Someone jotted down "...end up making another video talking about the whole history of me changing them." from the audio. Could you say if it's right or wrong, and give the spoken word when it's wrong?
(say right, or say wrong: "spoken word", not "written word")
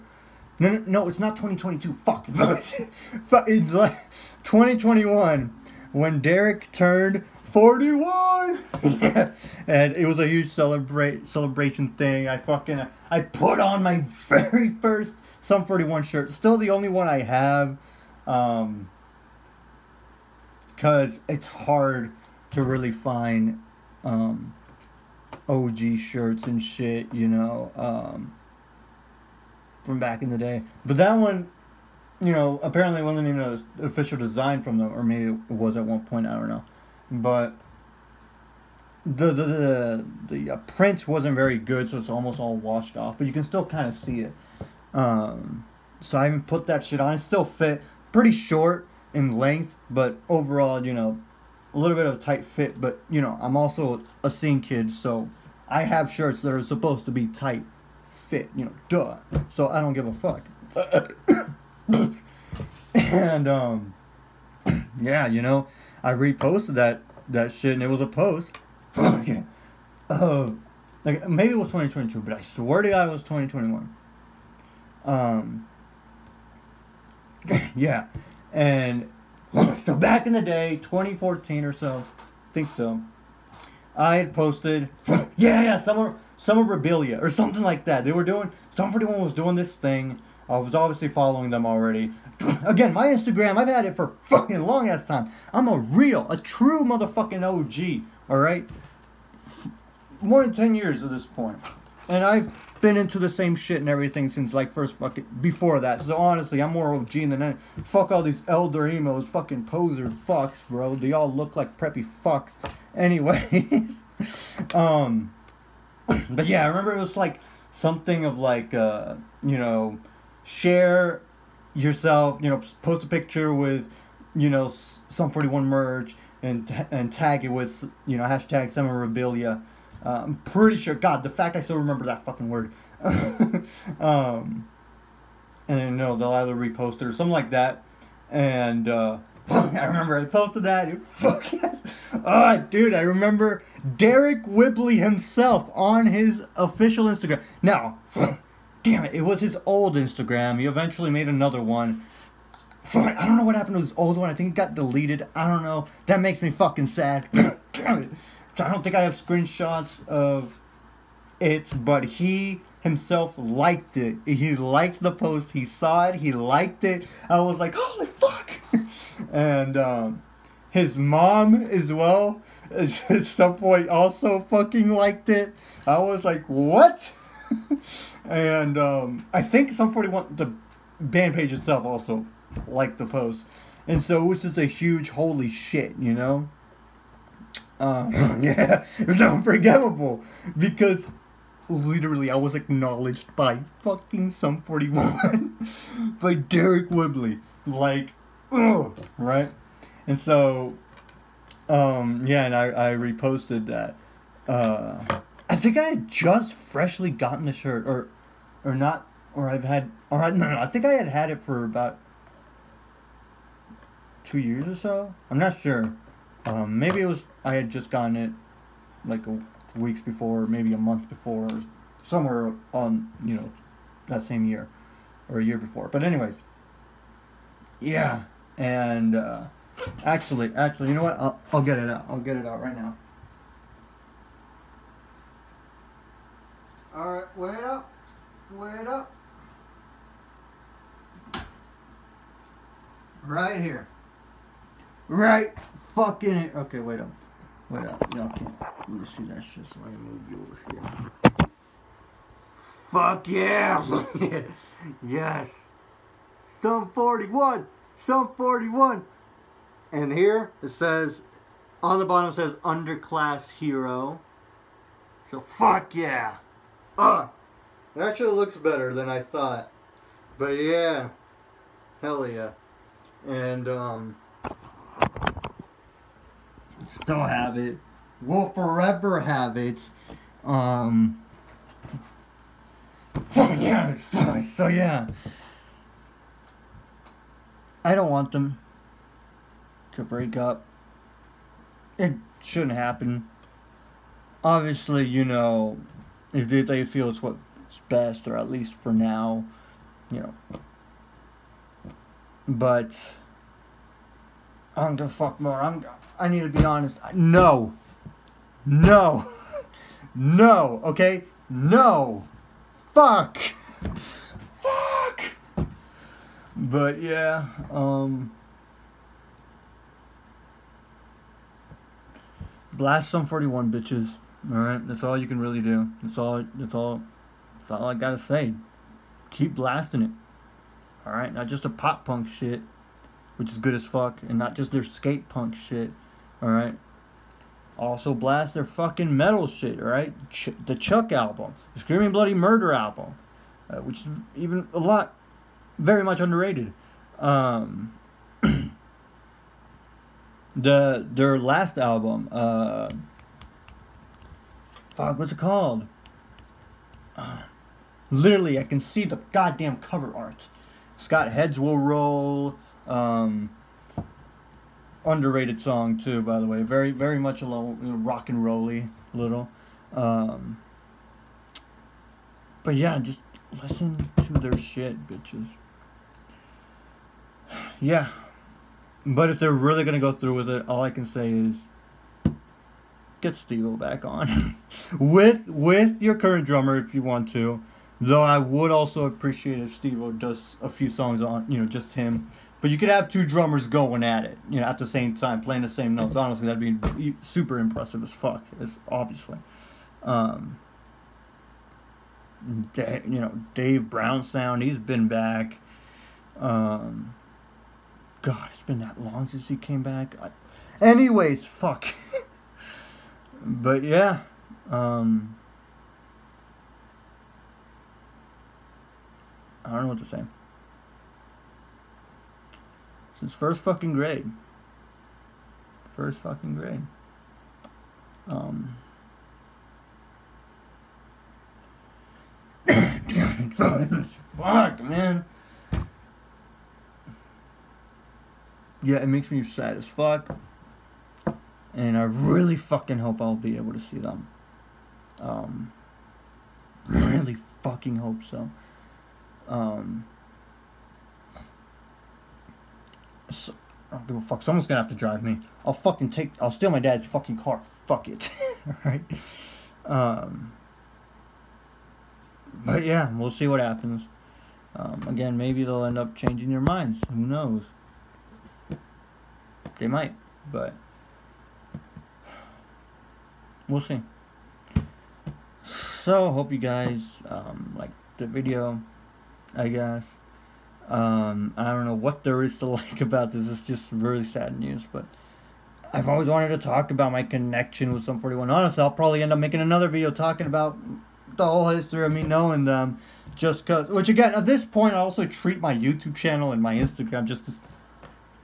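wrong: "knowing", not "changing".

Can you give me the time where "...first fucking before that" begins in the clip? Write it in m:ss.
1:44.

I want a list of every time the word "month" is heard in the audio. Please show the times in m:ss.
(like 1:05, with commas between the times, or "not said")
3:40.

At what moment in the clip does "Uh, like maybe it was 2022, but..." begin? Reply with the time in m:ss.
1:10.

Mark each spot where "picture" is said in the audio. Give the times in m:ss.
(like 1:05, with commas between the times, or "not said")
2:03.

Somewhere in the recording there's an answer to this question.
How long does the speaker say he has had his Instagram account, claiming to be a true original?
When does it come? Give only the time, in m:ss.
1:40.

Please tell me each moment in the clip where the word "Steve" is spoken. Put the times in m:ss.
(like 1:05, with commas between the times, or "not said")
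6:23, 6:29.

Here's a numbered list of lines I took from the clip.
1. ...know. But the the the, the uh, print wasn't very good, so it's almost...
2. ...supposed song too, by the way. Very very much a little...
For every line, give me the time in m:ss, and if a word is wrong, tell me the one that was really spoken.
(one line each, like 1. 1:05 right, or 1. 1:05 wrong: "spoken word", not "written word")
1. 0:36 right
2. 6:05 wrong: "underrated", not "supposed".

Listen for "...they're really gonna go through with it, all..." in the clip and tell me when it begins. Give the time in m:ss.
6:19.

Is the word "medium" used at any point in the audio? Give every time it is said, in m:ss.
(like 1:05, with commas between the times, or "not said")
not said.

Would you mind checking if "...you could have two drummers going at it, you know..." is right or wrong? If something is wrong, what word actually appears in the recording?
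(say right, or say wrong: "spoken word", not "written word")
right.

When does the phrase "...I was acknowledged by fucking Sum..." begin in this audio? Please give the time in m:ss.
3:12.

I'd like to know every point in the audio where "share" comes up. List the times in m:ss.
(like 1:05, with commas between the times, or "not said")
2:00.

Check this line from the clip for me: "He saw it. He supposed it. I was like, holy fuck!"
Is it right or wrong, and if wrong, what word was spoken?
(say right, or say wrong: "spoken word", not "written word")
wrong: "liked", not "supposed".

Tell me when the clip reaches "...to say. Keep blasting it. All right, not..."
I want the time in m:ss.
5:28.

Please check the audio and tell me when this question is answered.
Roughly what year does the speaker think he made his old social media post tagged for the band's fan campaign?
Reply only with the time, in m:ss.
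1:20.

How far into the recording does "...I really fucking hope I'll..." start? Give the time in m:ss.
7:21.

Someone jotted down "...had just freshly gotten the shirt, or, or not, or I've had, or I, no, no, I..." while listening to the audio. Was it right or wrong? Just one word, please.
right.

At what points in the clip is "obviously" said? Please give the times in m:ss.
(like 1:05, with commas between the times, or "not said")
1:30, 4:54, 6:38.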